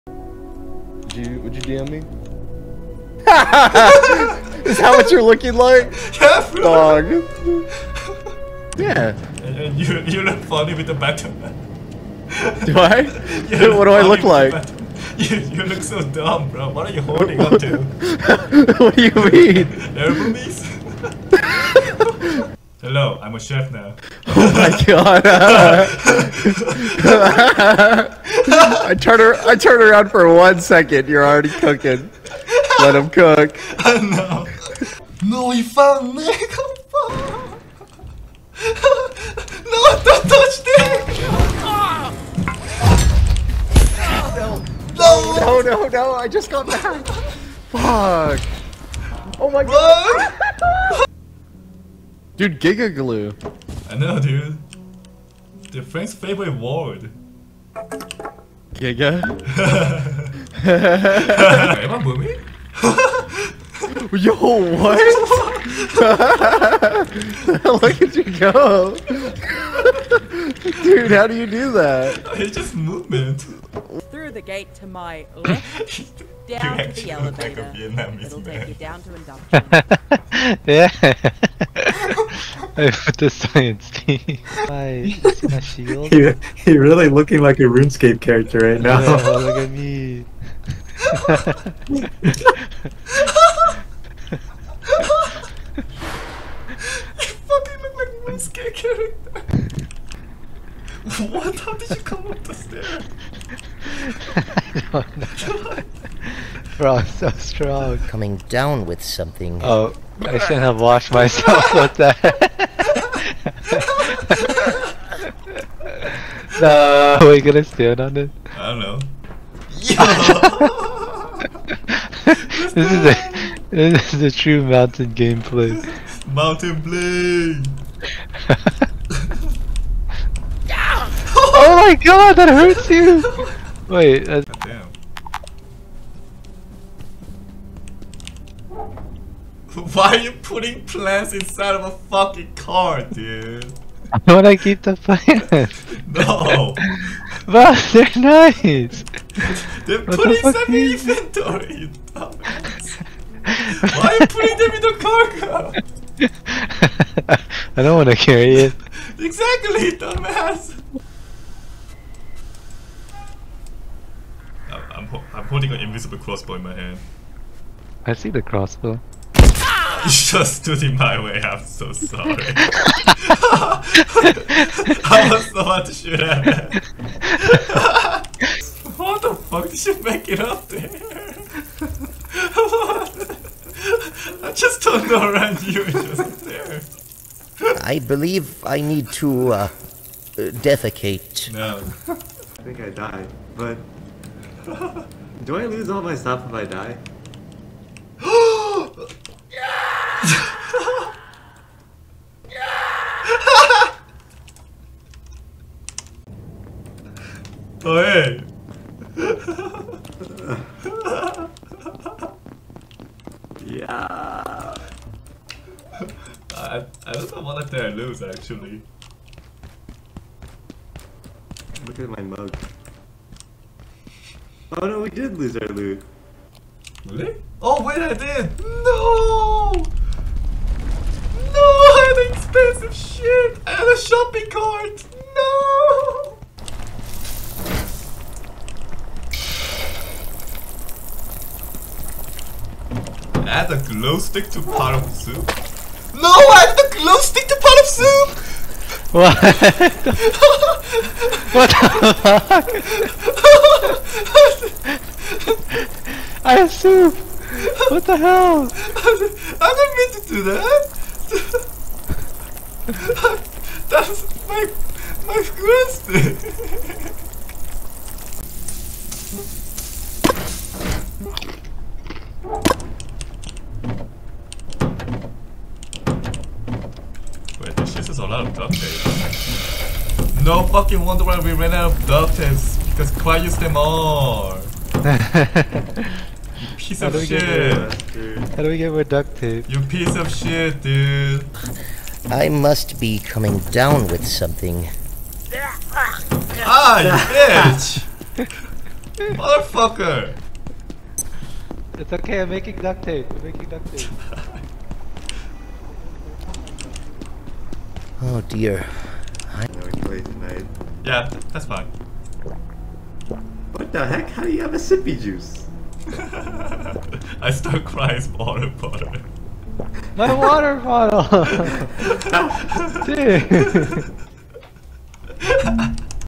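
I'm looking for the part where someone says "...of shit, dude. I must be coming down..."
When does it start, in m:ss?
4:50.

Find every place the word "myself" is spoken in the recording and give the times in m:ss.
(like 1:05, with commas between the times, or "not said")
1:51.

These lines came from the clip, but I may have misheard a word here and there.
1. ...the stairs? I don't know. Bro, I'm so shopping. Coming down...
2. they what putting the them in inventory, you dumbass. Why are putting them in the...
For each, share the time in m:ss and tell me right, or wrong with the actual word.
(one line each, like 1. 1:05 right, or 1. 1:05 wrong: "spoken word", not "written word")
1. 1:42 wrong: "strong", not "shopping"
2. 2:29 right.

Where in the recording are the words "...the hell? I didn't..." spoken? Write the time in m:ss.
4:18.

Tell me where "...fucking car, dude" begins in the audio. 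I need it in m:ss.
2:22.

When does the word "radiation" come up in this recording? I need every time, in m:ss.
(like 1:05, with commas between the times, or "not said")
not said.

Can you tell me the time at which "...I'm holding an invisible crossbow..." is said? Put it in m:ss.
2:45.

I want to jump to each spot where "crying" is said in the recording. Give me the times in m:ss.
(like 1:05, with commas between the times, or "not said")
5:17.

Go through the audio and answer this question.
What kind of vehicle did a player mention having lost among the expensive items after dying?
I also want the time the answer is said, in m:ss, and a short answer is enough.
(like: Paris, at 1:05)
Shopping cart, at 3:53.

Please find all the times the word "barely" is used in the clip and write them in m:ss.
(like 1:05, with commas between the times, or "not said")
not said.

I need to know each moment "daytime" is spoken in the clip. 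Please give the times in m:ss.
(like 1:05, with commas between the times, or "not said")
not said.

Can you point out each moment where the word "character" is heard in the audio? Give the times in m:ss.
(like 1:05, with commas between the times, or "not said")
1:28, 1:38.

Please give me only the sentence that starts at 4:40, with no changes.
No fucking wonder why we ran out of duct tape because Cry used them all.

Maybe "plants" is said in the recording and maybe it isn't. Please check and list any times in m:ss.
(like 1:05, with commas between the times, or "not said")
2:20, 2:24.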